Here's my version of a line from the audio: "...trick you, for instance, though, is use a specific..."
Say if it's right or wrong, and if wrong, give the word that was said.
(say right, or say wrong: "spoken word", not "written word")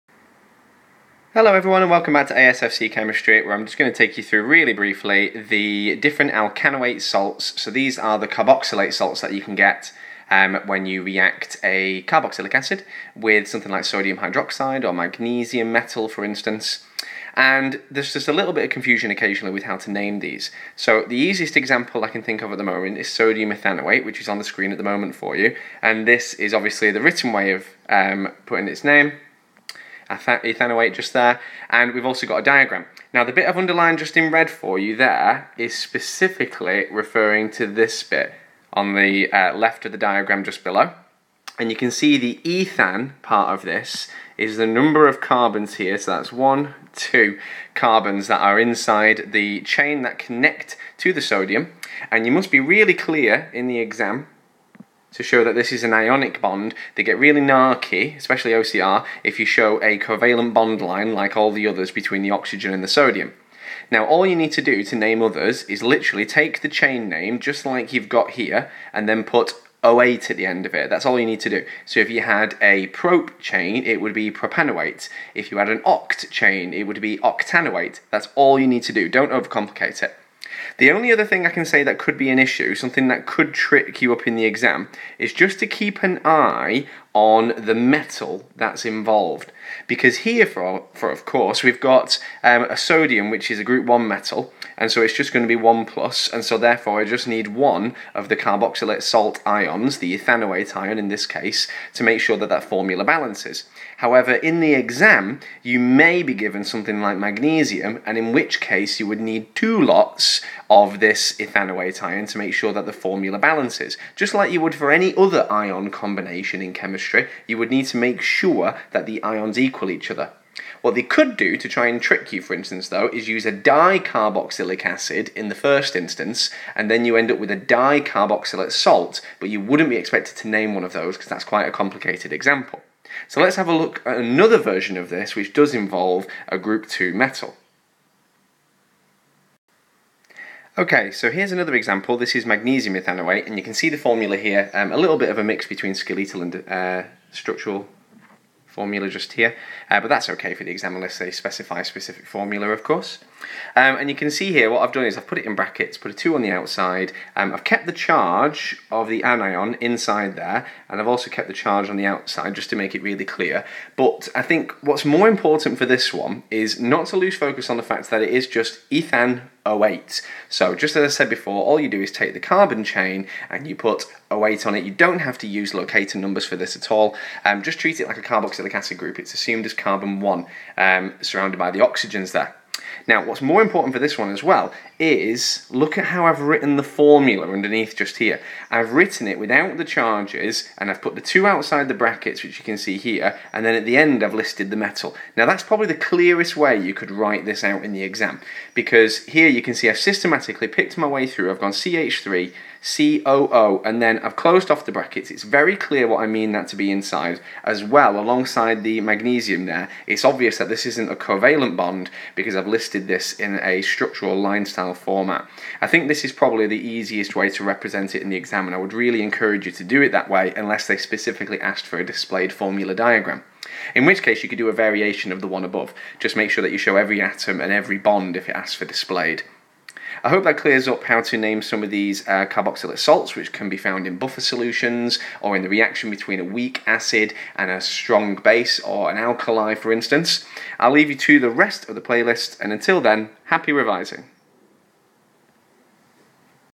wrong: "dicarboxylic", not "specific".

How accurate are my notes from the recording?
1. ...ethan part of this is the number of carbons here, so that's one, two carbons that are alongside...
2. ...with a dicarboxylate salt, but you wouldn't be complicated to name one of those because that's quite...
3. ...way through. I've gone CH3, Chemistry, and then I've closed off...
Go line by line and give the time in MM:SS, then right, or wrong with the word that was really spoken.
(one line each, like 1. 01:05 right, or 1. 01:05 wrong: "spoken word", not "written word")
1. 00:42 wrong: "inside", not "alongside"
2. 02:07 wrong: "expected", not "complicated"
3. 03:21 wrong: "COO", not "Chemistry".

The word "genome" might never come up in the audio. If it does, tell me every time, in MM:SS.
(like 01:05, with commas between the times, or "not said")
not said.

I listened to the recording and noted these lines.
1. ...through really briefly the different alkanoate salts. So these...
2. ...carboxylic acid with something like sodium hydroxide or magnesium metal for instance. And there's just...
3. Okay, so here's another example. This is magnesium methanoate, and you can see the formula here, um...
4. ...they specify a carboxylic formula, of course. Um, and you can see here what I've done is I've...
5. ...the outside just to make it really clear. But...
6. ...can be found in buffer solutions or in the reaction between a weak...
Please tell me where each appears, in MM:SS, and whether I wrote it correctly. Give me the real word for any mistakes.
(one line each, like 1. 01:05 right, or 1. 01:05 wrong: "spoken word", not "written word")
1. 00:04 right
2. 00:12 right
3. 02:20 right
4. 02:31 wrong: "specific", not "carboxylic"
5. 02:41 right
6. 03:53 right.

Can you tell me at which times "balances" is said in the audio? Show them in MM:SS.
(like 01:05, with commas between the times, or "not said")
01:43, 01:53.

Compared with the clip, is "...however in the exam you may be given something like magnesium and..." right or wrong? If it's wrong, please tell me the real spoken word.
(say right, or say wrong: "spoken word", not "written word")
right.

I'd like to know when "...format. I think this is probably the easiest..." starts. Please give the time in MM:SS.
03:34.